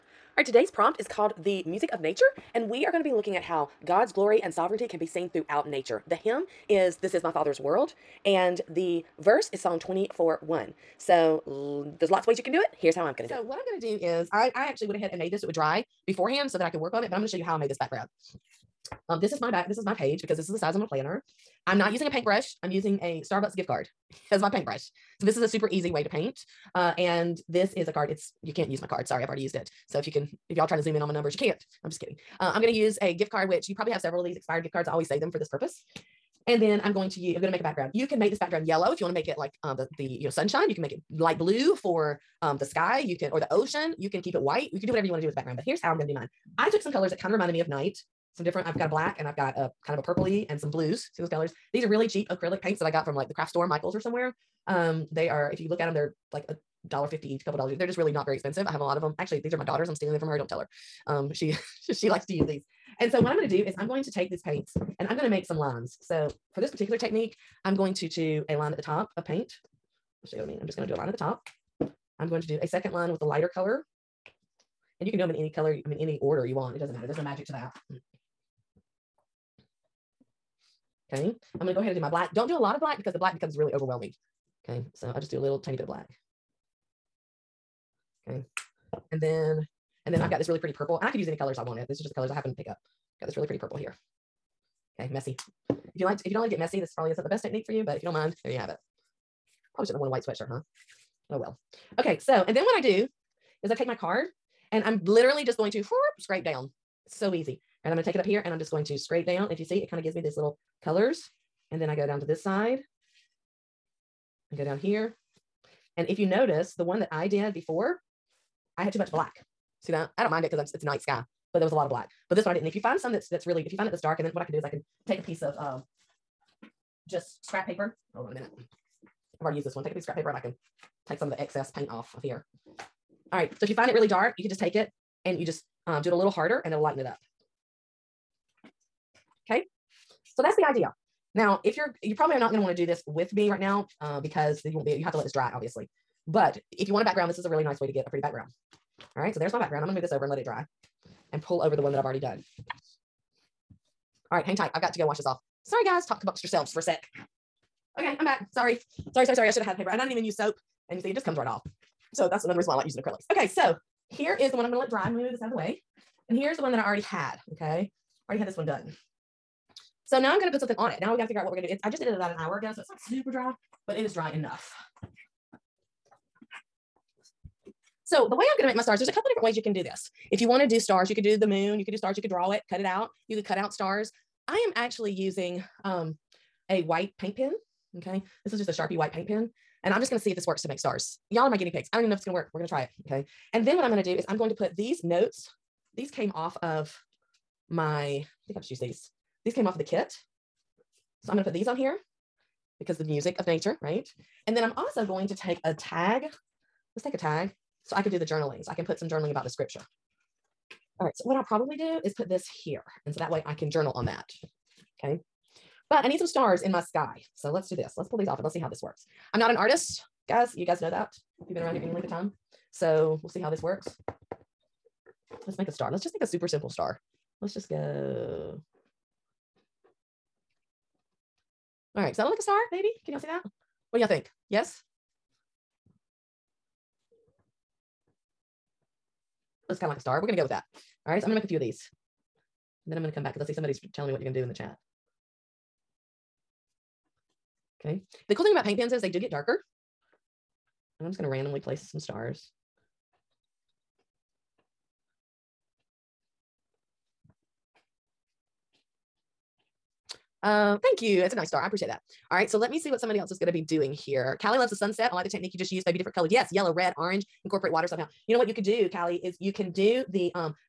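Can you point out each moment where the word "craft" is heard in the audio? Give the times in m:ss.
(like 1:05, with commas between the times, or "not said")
0:53.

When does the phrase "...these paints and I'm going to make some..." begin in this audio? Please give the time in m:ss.
1:04.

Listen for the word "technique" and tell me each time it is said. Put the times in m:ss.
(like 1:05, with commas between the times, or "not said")
1:06, 1:37, 4:25.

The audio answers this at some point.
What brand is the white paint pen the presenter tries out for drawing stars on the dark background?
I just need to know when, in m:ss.
3:08.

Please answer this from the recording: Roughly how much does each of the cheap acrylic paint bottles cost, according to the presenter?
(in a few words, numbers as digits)
$1.50.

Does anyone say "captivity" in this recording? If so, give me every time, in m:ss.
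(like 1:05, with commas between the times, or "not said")
not said.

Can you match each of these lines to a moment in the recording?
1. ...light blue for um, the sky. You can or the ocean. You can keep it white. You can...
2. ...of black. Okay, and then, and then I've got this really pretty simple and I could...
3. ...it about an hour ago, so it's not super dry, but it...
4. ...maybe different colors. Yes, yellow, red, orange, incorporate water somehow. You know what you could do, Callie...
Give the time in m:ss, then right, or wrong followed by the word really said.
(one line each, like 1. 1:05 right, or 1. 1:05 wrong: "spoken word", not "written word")
1. 0:41 right
2. 1:25 wrong: "purple", not "simple"
3. 2:52 right
4. 4:25 right.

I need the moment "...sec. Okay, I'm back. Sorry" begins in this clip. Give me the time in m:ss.
2:36.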